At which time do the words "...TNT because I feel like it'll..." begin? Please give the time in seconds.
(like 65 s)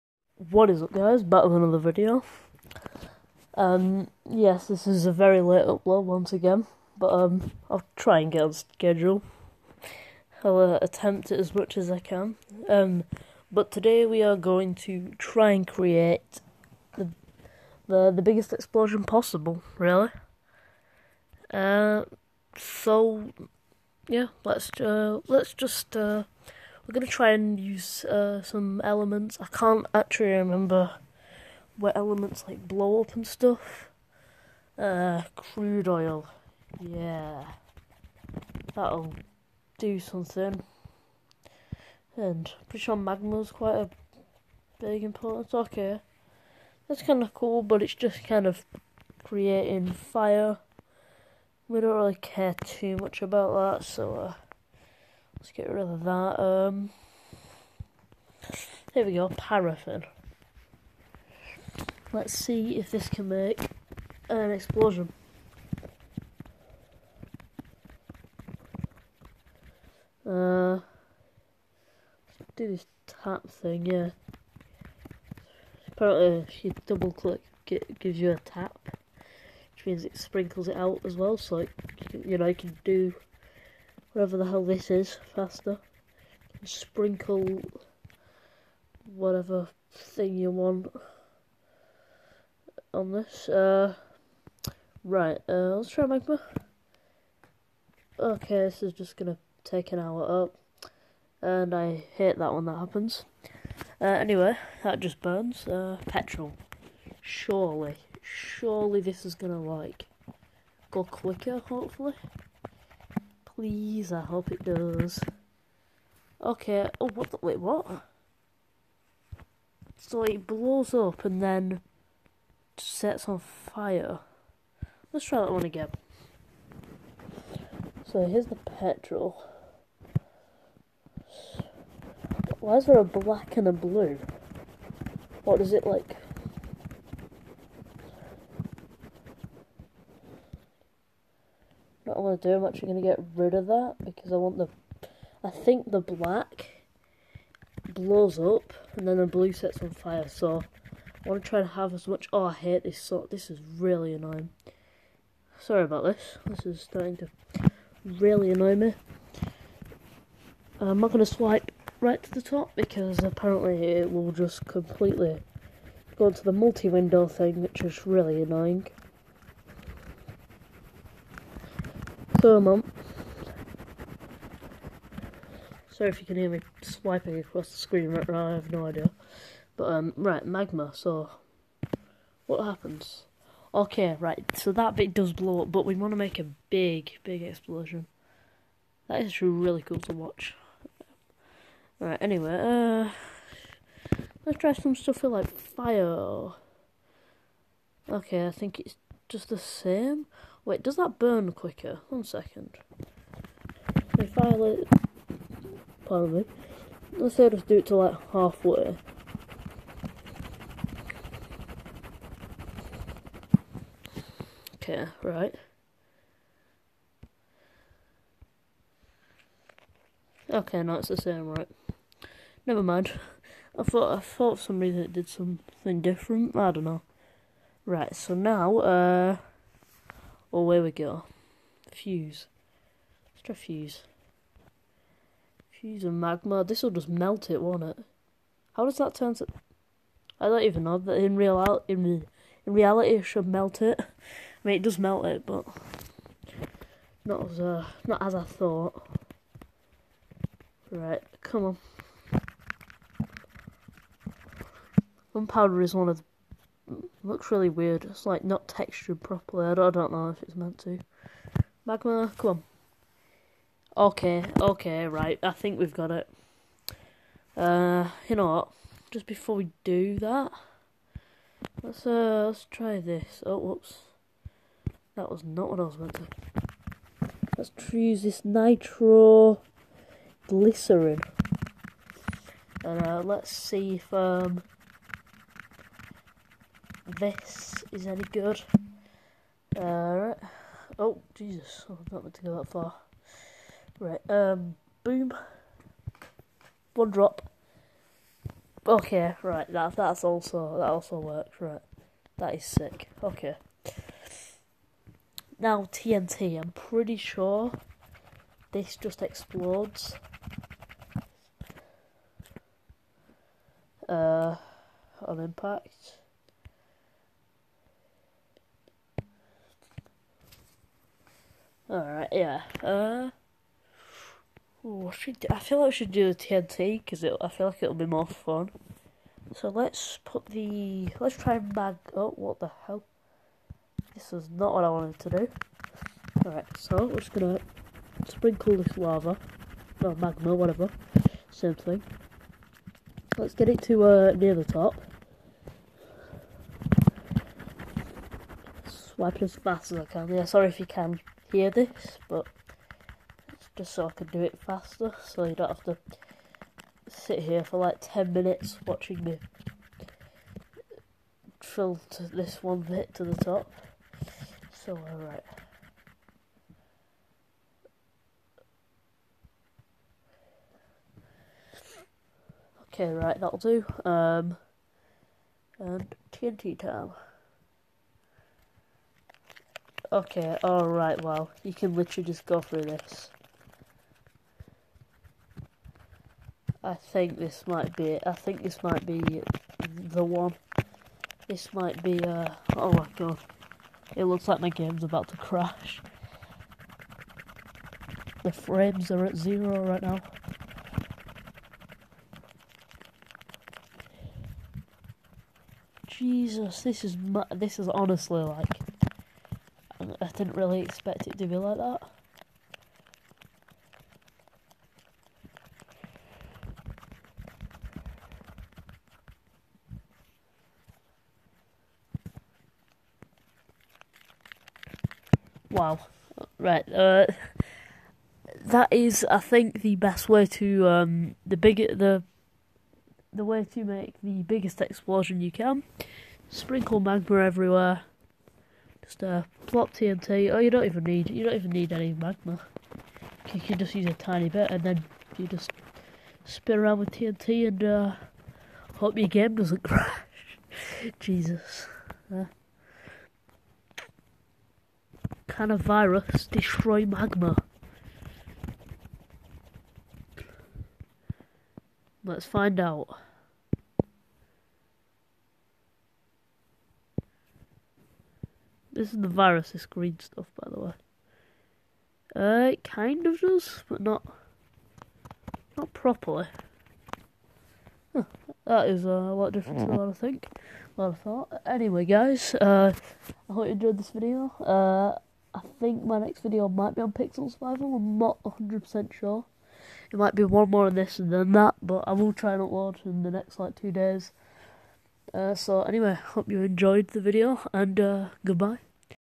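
326 s.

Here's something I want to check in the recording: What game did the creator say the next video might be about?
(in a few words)
Pixel Survival.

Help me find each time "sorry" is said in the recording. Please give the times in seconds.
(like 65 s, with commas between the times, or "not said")
155 s, 175 s, 350 s.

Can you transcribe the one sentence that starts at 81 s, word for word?
So, it, you know, you can do wherever the hell this is faster.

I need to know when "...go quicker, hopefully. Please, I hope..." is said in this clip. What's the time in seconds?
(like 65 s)
110 s.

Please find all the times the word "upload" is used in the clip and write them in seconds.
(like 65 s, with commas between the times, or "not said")
5 s, 492 s.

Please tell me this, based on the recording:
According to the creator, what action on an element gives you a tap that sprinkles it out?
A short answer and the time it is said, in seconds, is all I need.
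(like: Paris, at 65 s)
Double click, at 76 s.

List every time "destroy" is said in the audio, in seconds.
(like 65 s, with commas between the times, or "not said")
456 s.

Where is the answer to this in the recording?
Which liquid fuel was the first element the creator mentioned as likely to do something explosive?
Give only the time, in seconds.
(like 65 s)
35 s.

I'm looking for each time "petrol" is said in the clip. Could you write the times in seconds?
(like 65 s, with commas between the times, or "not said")
106 s, 128 s.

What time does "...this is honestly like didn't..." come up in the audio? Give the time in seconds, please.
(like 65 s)
407 s.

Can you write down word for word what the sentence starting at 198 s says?
Okay, I think it's just the same.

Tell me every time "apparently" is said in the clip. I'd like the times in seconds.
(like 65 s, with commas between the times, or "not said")
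75 s, 163 s.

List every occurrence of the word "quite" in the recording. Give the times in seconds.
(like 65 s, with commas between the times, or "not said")
43 s.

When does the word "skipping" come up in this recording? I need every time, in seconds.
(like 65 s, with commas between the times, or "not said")
not said.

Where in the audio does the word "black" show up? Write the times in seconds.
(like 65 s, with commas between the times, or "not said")
133 s, 146 s.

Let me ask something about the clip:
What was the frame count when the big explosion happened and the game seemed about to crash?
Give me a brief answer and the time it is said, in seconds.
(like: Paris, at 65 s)
0, at 399 s.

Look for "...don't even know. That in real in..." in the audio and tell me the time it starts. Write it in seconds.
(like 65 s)
240 s.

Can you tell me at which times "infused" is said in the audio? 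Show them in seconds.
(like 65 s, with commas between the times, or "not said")
not said.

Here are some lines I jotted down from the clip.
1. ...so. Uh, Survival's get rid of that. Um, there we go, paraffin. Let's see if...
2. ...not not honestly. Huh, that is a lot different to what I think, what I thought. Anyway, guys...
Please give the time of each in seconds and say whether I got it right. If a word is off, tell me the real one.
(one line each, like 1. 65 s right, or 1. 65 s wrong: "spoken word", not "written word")
1. 53 s wrong: "Let", not "Survival"
2. 473 s wrong: "properly", not "honestly".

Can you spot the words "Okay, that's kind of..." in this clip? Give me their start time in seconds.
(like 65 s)
45 s.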